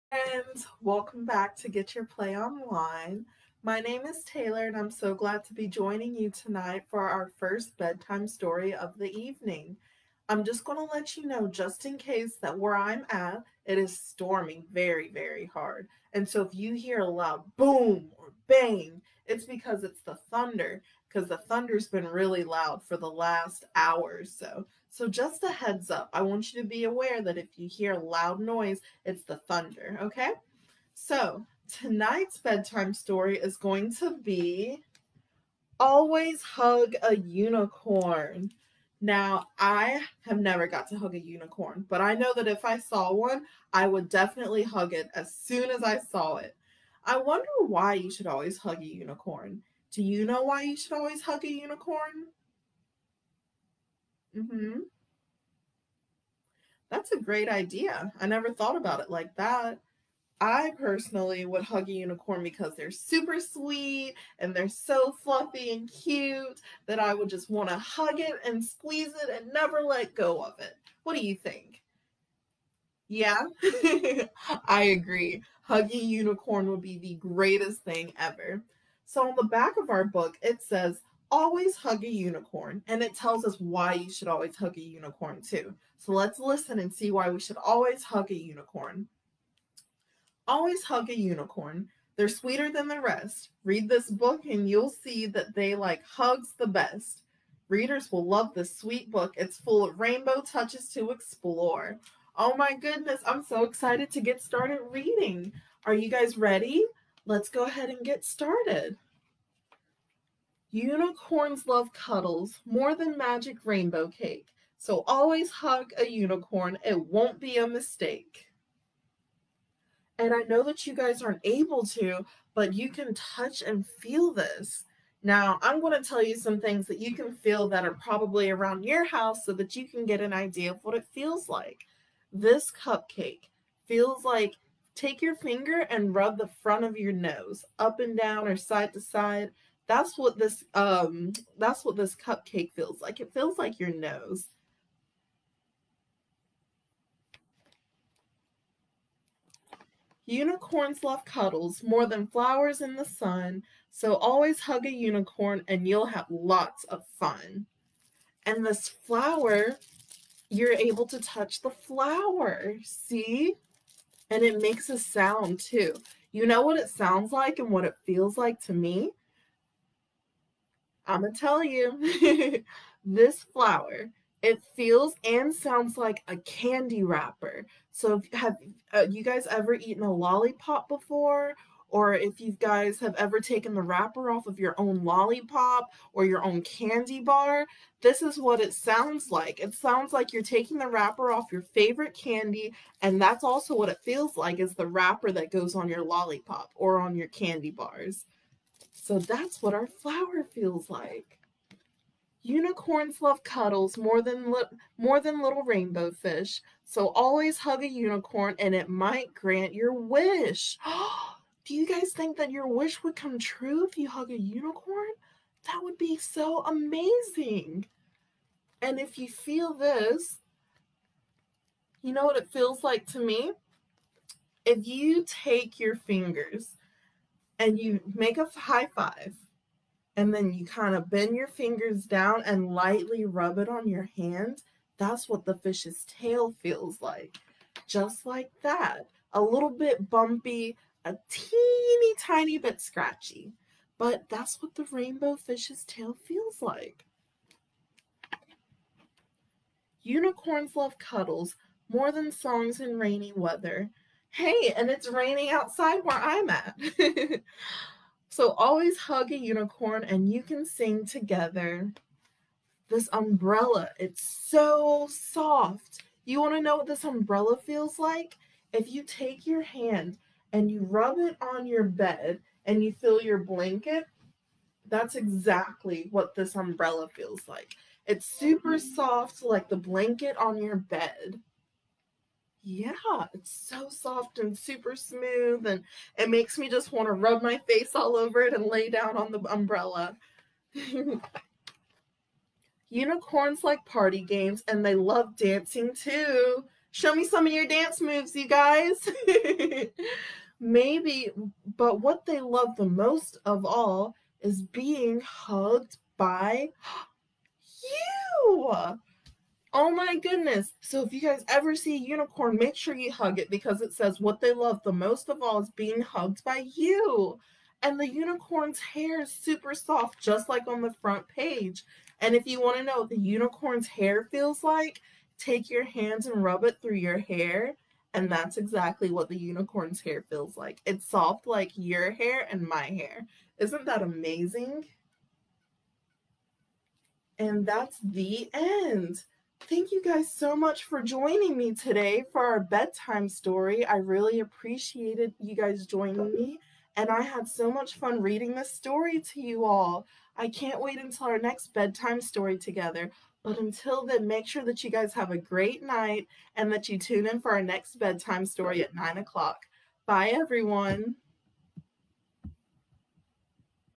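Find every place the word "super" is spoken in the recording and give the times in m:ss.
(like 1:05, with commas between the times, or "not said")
1:02, 4:38, 4:44, 5:19.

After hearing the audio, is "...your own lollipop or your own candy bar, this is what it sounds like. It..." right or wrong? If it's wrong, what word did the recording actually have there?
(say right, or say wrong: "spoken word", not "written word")
right.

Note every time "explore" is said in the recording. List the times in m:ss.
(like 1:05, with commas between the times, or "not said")
1:41.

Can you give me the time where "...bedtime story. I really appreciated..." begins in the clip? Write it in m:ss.
5:42.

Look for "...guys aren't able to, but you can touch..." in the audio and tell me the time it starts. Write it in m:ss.
2:00.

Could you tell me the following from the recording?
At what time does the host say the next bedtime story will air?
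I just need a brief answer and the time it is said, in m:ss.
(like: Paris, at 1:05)
9 o'clock, at 5:58.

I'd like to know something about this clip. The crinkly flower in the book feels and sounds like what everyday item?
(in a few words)
A candy wrapper.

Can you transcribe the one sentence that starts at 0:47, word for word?
I wonder why you should always hug a unicorn.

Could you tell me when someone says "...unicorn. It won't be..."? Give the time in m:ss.
1:56.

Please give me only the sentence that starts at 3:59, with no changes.
A little bit bumpy, a teeny tiny bit scratchy, but that's what the rainbow fish's tail feels like.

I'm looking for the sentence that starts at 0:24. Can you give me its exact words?
So just a heads up, I want you to be aware that if you hear loud noise, it's the thunder, okay?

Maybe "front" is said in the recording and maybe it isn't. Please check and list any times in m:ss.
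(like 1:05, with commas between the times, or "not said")
2:16, 5:21.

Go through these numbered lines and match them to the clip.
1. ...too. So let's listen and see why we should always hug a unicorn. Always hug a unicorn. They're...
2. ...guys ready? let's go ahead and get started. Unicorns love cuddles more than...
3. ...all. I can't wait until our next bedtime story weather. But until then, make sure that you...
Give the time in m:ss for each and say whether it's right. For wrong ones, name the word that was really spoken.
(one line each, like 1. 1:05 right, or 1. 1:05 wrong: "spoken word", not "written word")
1. 1:25 right
2. 1:46 right
3. 5:49 wrong: "together", not "weather".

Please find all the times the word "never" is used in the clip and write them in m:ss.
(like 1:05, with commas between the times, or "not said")
0:40, 0:58, 1:09.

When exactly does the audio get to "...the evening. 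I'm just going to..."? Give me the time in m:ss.
0:08.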